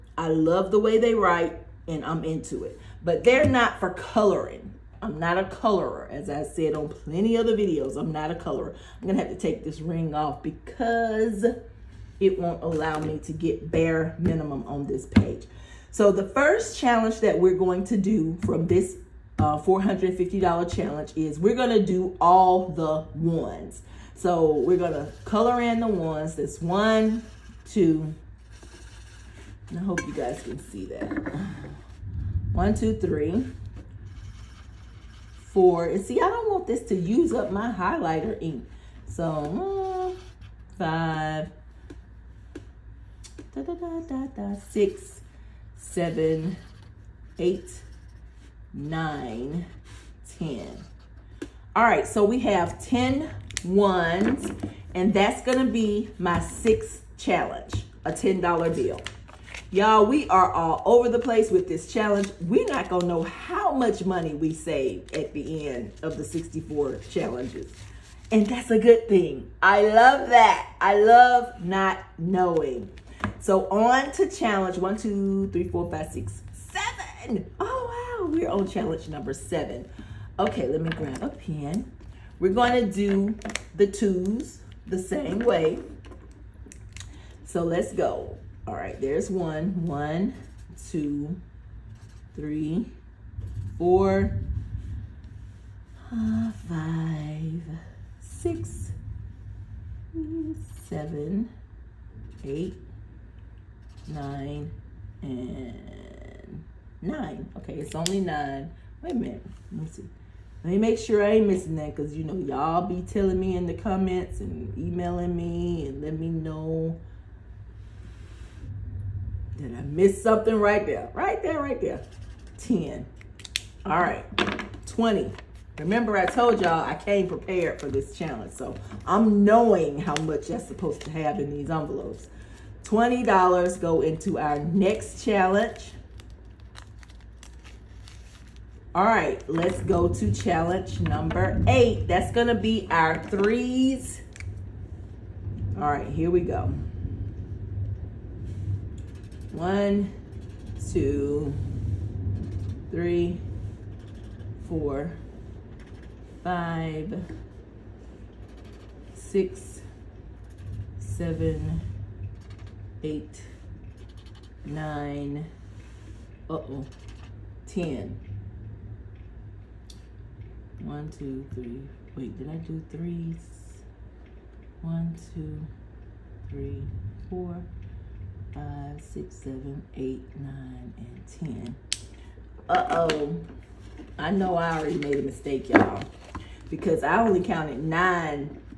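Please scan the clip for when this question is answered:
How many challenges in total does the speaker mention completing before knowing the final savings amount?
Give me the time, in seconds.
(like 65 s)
66 s.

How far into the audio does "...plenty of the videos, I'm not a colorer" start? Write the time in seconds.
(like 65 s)
6 s.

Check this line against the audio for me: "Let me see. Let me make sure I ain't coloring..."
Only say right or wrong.
wrong.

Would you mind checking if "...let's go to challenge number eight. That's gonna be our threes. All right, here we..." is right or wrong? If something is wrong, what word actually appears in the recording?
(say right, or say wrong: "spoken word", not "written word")
right.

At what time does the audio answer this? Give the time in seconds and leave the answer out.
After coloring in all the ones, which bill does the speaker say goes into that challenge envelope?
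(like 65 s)
58 s.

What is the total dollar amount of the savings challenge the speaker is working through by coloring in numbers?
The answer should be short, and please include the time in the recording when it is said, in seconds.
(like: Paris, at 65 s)
$450, at 19 s.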